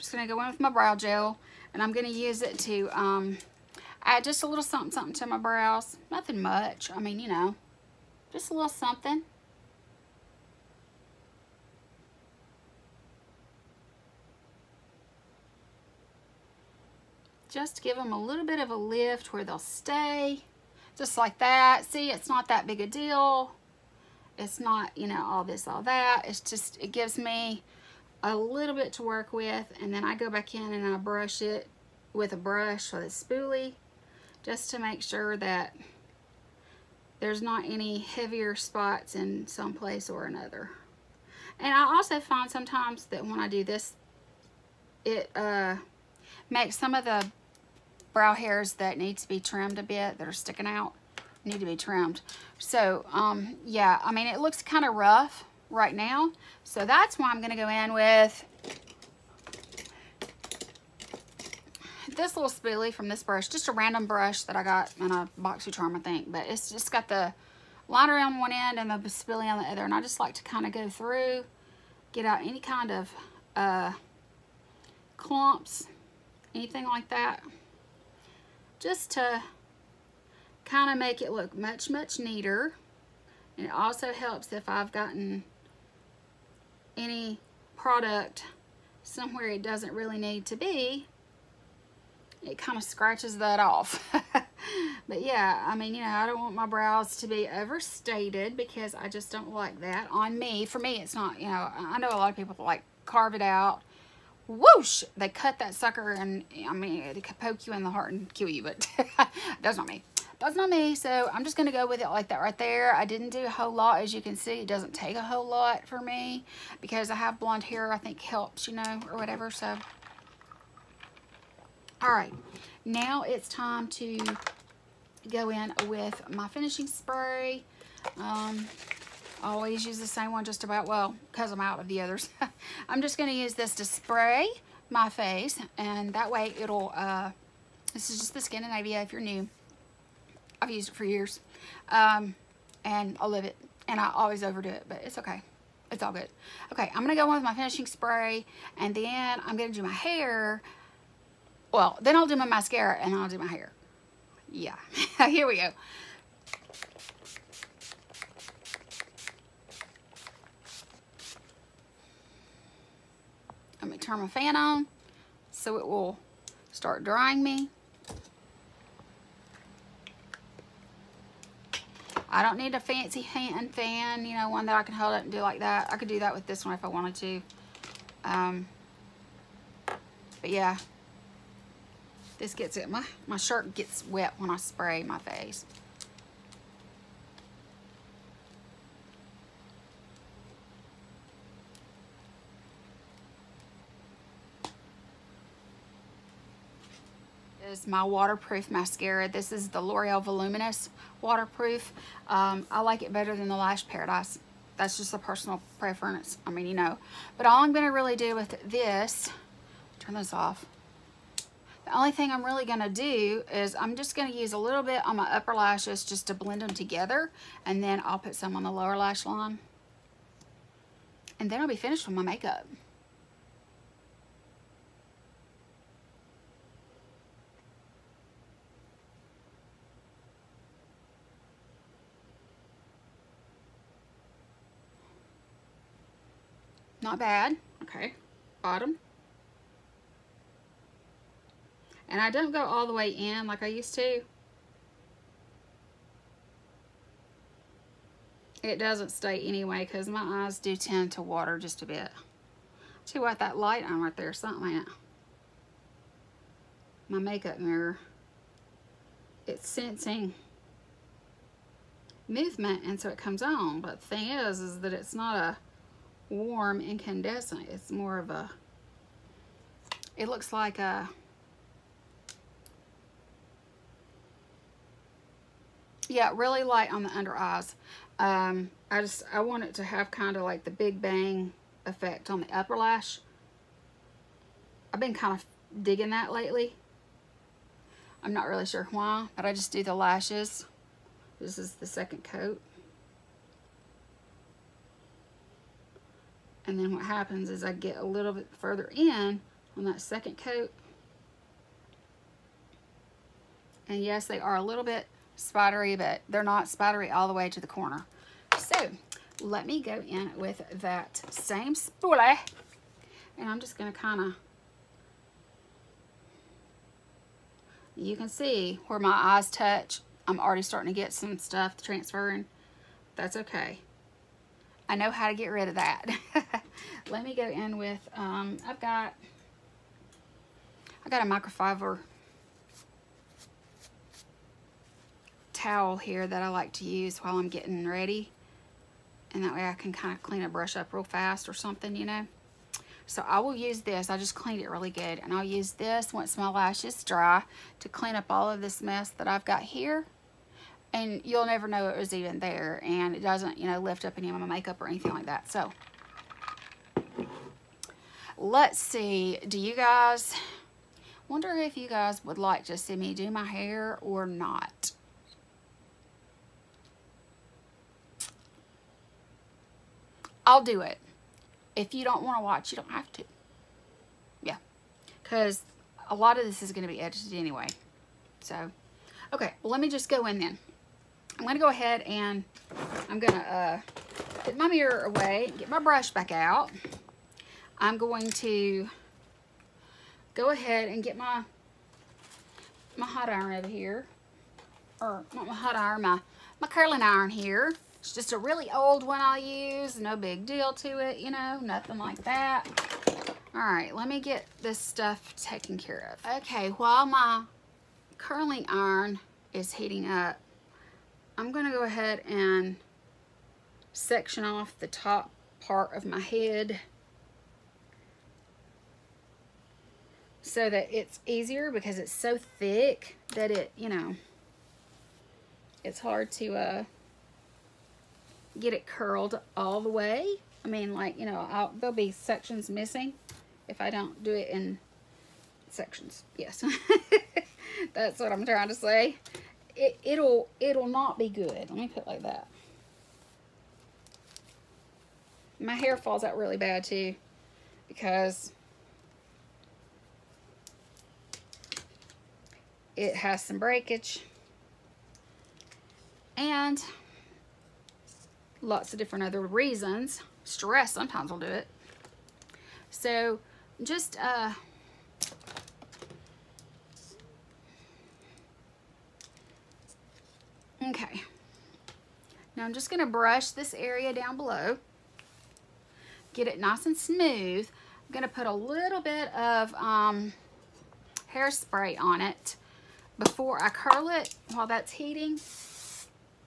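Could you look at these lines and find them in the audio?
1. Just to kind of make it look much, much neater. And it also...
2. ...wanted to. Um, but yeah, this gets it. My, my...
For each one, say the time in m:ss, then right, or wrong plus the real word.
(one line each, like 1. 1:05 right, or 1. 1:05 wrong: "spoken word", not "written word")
1. 1:18 right
2. 2:56 right.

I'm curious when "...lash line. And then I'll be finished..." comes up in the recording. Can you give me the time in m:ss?
3:38.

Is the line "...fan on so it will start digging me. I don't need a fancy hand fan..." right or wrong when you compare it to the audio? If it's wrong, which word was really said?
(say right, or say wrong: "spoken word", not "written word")
wrong: "drying", not "digging".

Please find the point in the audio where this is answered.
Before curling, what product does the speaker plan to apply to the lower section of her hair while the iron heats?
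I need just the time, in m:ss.
8:01.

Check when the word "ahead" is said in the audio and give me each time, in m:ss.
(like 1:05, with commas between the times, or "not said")
6:21, 6:30, 6:51.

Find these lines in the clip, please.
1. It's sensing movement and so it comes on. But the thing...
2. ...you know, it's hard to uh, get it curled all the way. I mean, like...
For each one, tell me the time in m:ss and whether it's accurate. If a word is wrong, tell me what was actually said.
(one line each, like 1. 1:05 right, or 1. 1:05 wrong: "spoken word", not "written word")
1. 4:19 right
2. 7:03 right.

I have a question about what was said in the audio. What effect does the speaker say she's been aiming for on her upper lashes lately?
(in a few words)
Big bang effect.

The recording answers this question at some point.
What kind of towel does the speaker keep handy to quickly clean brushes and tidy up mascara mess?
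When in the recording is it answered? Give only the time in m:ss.
5:31.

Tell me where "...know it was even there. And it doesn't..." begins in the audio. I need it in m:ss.
5:51.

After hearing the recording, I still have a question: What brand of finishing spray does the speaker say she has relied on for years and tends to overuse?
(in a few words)
Skindinavia.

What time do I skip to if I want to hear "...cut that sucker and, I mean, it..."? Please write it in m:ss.
1:45.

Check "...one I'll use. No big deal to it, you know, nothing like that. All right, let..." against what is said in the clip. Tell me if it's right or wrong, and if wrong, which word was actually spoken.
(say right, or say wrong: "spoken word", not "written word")
right.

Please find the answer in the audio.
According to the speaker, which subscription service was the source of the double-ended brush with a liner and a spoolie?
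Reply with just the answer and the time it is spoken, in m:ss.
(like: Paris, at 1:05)
BoxyCharm, at 1:05.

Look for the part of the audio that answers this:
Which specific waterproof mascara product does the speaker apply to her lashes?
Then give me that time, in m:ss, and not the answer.
3:19.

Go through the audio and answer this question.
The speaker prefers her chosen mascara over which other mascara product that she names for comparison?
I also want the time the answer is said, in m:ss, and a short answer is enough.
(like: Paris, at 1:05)
Lash Paradise, at 3:23.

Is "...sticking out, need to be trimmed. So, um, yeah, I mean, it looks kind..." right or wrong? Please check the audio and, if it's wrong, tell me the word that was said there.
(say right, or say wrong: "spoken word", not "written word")
right.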